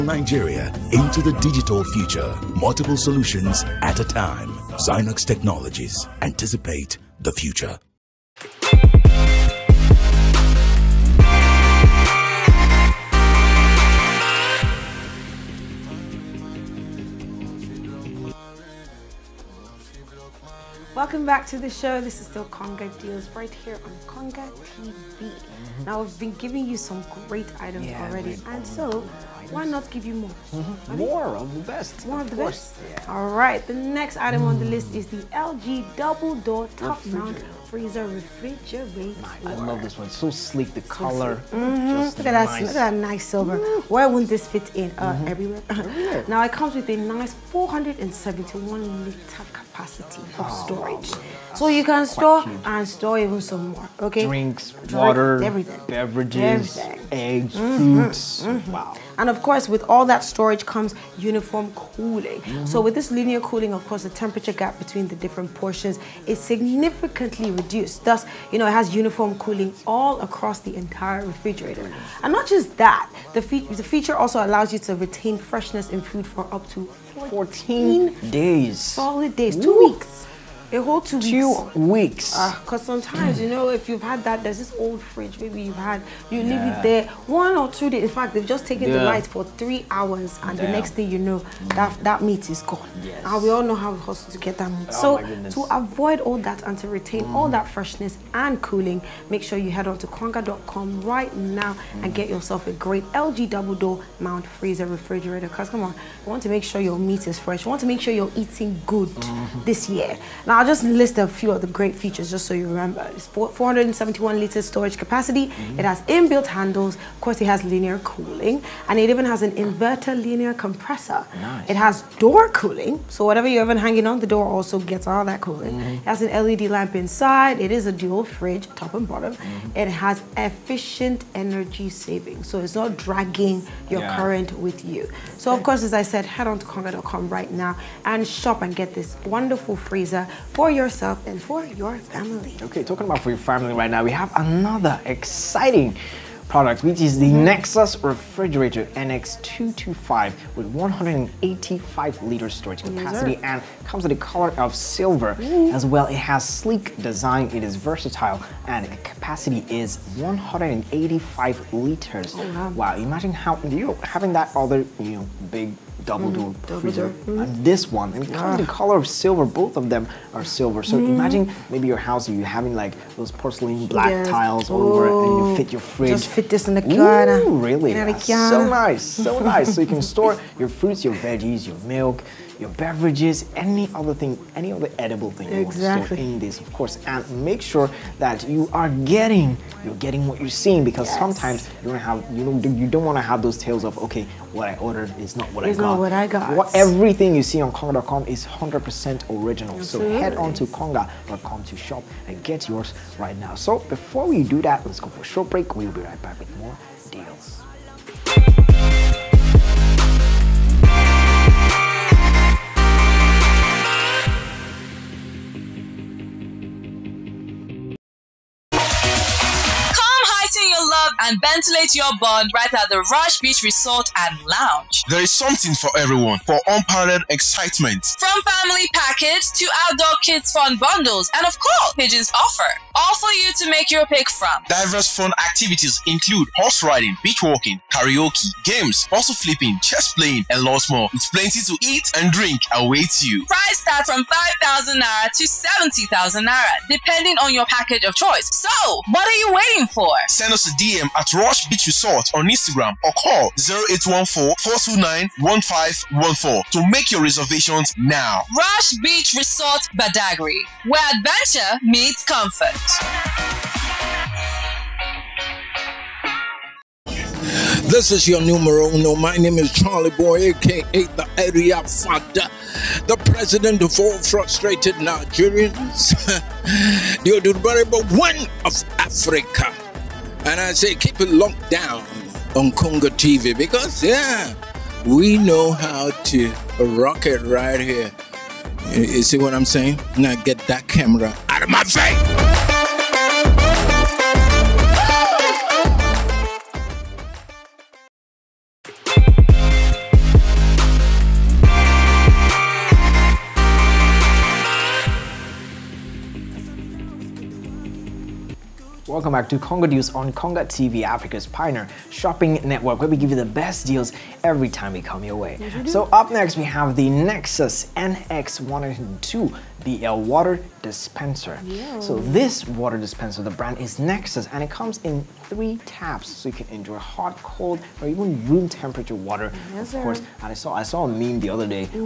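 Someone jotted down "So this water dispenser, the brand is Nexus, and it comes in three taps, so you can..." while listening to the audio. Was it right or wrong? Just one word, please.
right.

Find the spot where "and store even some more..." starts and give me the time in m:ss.
0:52.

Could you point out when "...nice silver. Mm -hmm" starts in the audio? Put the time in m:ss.
0:43.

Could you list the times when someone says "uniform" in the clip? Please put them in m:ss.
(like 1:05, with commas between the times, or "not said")
1:01, 1:08.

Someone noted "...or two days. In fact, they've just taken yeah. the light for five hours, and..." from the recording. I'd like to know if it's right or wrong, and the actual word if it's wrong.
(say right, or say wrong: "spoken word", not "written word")
wrong: "three", not "five".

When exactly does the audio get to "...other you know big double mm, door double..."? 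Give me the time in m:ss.
2:44.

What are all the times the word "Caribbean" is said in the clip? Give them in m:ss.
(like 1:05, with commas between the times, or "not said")
not said.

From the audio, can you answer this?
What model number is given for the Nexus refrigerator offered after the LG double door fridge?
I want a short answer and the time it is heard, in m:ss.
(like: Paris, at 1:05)
NX225, at 2:28.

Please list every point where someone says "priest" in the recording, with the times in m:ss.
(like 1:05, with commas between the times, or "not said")
not said.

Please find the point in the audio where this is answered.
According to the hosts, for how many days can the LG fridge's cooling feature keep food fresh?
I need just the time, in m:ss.
1:18.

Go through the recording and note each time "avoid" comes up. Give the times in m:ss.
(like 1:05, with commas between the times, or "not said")
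1:35.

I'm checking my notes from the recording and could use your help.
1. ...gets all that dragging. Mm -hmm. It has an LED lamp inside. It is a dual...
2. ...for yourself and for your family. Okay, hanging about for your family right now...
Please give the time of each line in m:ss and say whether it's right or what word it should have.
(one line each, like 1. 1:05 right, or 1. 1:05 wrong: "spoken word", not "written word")
1. 2:04 wrong: "cooling", not "dragging"
2. 2:20 wrong: "talking", not "hanging".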